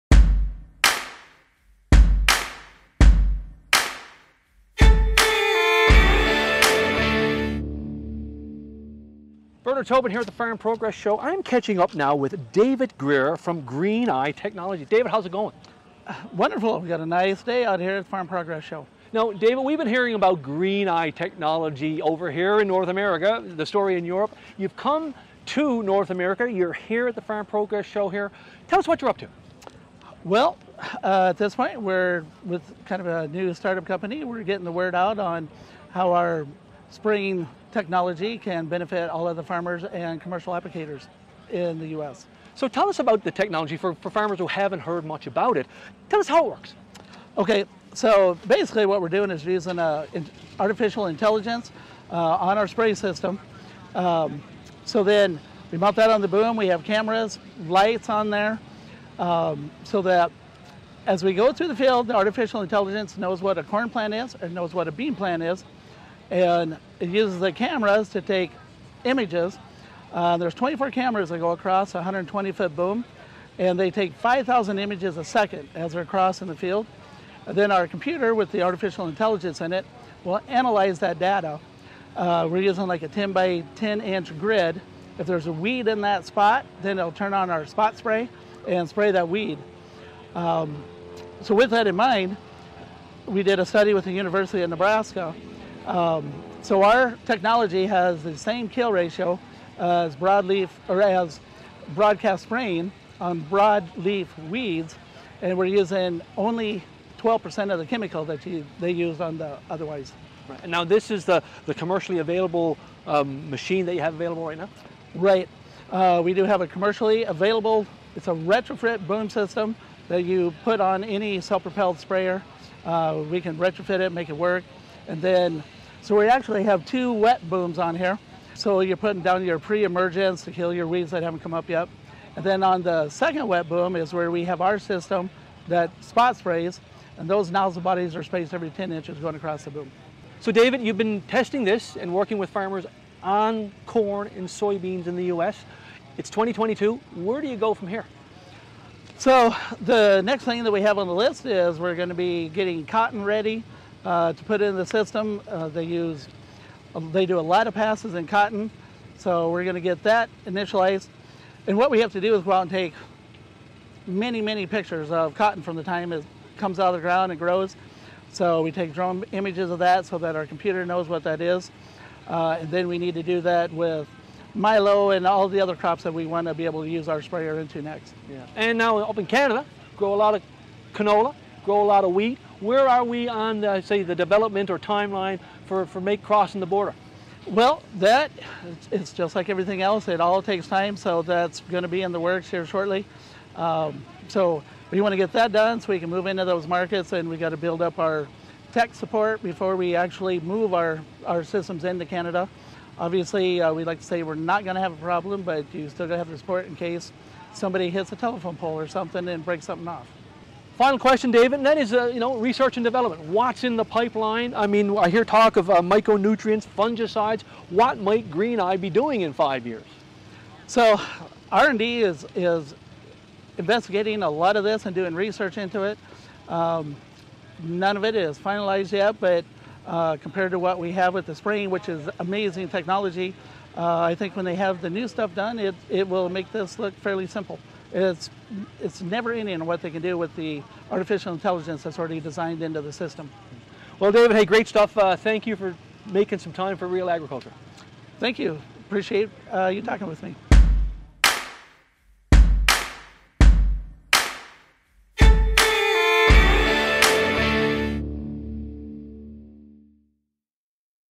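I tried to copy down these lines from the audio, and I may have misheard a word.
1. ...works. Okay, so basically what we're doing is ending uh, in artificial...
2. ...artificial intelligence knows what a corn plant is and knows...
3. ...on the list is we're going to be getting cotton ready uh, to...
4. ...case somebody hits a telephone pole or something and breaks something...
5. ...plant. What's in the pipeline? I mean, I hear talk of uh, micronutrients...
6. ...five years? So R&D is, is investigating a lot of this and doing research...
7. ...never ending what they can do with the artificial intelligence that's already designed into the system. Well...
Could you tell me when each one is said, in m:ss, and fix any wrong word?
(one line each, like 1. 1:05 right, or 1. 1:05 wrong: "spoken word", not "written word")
1. 0:46 wrong: "using", not "ending"
2. 1:02 right
3. 2:30 right
4. 3:26 right
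5. 3:32 wrong: "development", not "plant"
6. 3:39 right
7. 3:59 right.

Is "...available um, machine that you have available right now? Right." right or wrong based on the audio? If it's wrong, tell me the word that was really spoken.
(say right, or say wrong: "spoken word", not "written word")
right.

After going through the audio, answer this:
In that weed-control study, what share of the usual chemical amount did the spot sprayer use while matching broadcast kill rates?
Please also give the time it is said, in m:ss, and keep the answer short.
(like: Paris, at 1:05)
12%, at 1:47.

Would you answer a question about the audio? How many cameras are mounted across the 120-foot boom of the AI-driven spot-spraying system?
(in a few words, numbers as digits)
24.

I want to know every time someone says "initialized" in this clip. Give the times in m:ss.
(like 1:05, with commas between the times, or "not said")
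2:40.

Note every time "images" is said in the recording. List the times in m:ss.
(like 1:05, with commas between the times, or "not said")
1:09, 1:14, 2:49.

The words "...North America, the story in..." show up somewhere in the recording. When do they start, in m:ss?
0:22.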